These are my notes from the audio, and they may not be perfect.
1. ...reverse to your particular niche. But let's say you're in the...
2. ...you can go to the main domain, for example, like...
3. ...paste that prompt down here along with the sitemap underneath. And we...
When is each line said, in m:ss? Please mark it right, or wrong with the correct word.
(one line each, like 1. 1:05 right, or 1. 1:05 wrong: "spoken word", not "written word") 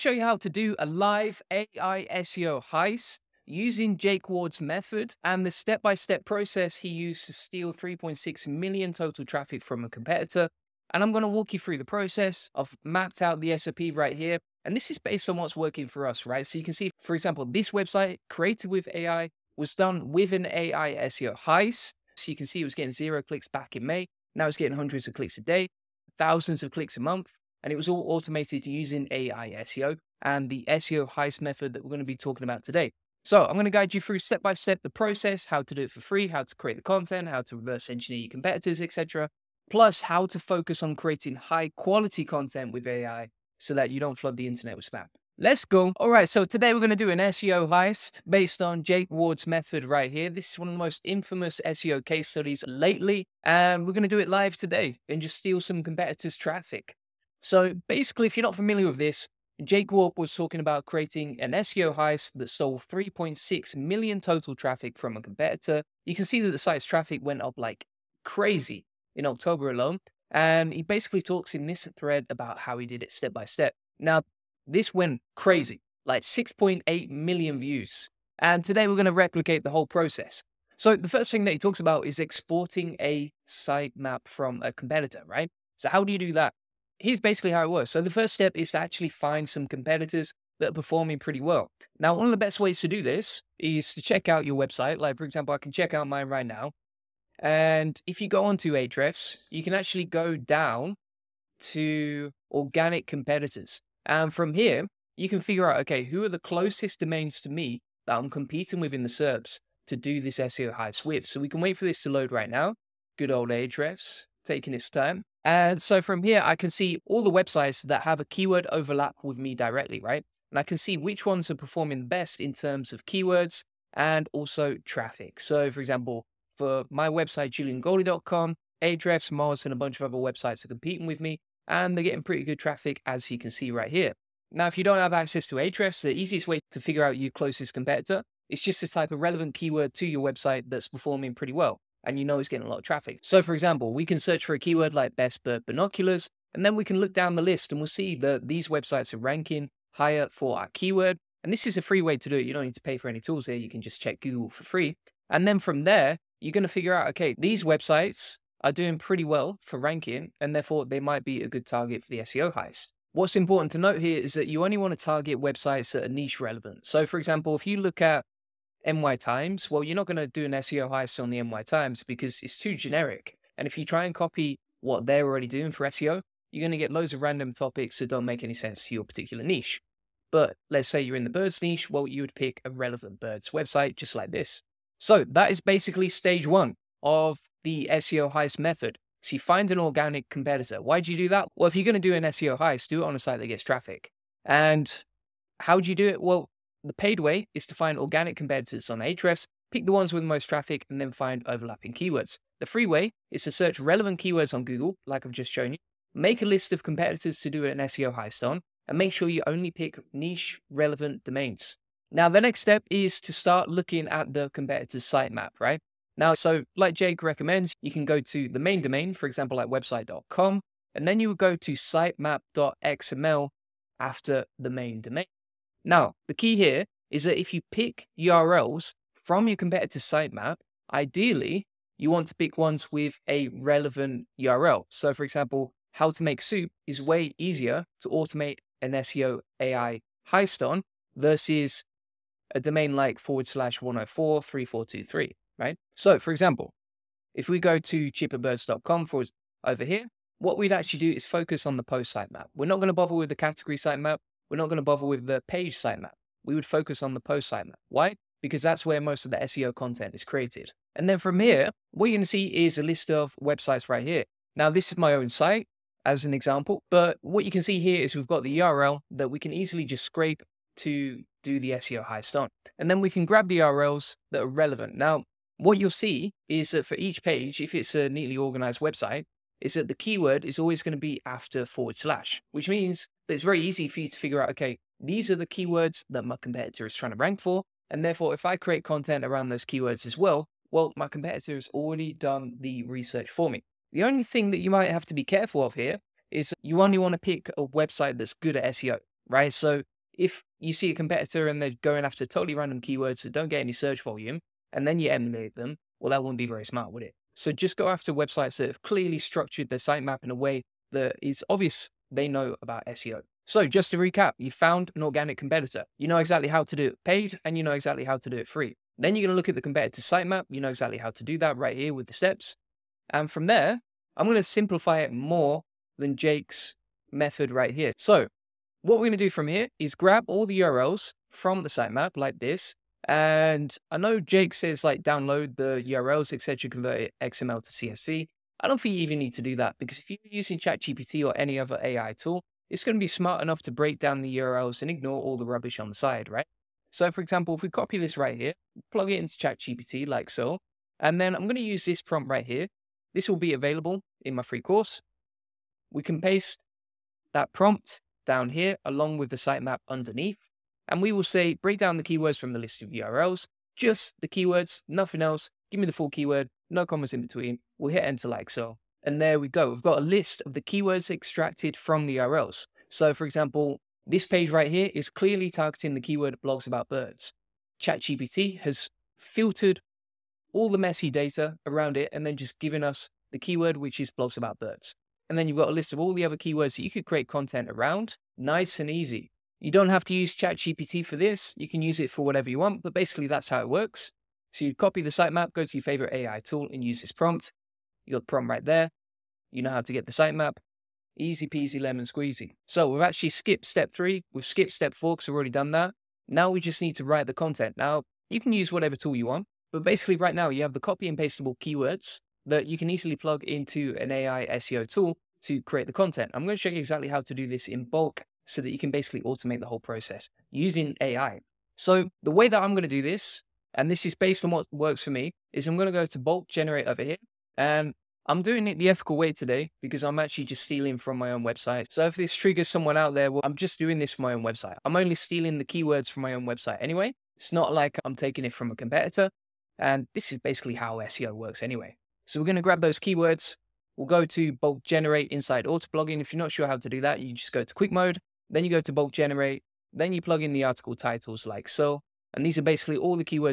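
1. 2:58 wrong: "sense", not "reverse"
2. 3:37 right
3. 5:56 right.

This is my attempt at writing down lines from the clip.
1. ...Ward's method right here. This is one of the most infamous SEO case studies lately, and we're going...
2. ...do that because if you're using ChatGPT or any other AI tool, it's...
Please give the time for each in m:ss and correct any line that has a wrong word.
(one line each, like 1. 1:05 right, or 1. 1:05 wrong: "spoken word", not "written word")
1. 0:49 right
2. 5:39 right.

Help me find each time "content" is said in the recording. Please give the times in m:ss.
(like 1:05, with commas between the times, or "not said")
0:36, 0:42, 4:19, 4:48, 6:27, 6:47, 6:55.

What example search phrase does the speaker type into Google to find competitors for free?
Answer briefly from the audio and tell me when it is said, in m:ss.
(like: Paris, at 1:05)
best bird binoculars, at 2:25.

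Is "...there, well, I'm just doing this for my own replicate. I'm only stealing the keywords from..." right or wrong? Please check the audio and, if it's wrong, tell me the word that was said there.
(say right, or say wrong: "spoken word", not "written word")
wrong: "website", not "replicate".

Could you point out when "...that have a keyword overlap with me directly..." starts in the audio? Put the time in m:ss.
1:57.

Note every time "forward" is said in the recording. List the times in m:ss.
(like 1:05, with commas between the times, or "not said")
4:03, 4:09, 4:41.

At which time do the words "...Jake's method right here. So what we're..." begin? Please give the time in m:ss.
5:26.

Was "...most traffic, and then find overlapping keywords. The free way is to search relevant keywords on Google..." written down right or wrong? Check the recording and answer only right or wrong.
right.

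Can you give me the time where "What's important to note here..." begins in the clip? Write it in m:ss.
2:43.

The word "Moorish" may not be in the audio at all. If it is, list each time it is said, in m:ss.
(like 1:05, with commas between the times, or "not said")
not said.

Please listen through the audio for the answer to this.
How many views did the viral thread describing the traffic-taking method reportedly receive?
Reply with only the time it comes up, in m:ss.
1:16.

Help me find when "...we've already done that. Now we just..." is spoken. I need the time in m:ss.
6:45.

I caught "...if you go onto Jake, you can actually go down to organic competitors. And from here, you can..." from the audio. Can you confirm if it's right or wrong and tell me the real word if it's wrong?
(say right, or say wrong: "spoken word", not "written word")
wrong: "Ahrefs", not "Jake".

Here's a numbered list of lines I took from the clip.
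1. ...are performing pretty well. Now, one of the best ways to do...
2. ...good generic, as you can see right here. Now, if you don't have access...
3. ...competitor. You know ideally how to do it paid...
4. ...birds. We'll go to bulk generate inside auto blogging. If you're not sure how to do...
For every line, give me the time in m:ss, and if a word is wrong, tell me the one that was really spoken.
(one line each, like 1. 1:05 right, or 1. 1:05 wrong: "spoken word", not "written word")
1. 1:30 right
2. 2:12 wrong: "traffic", not "generic"
3. 5:15 wrong: "exactly", not "ideally"
4. 7:22 wrong: "keywords", not "birds".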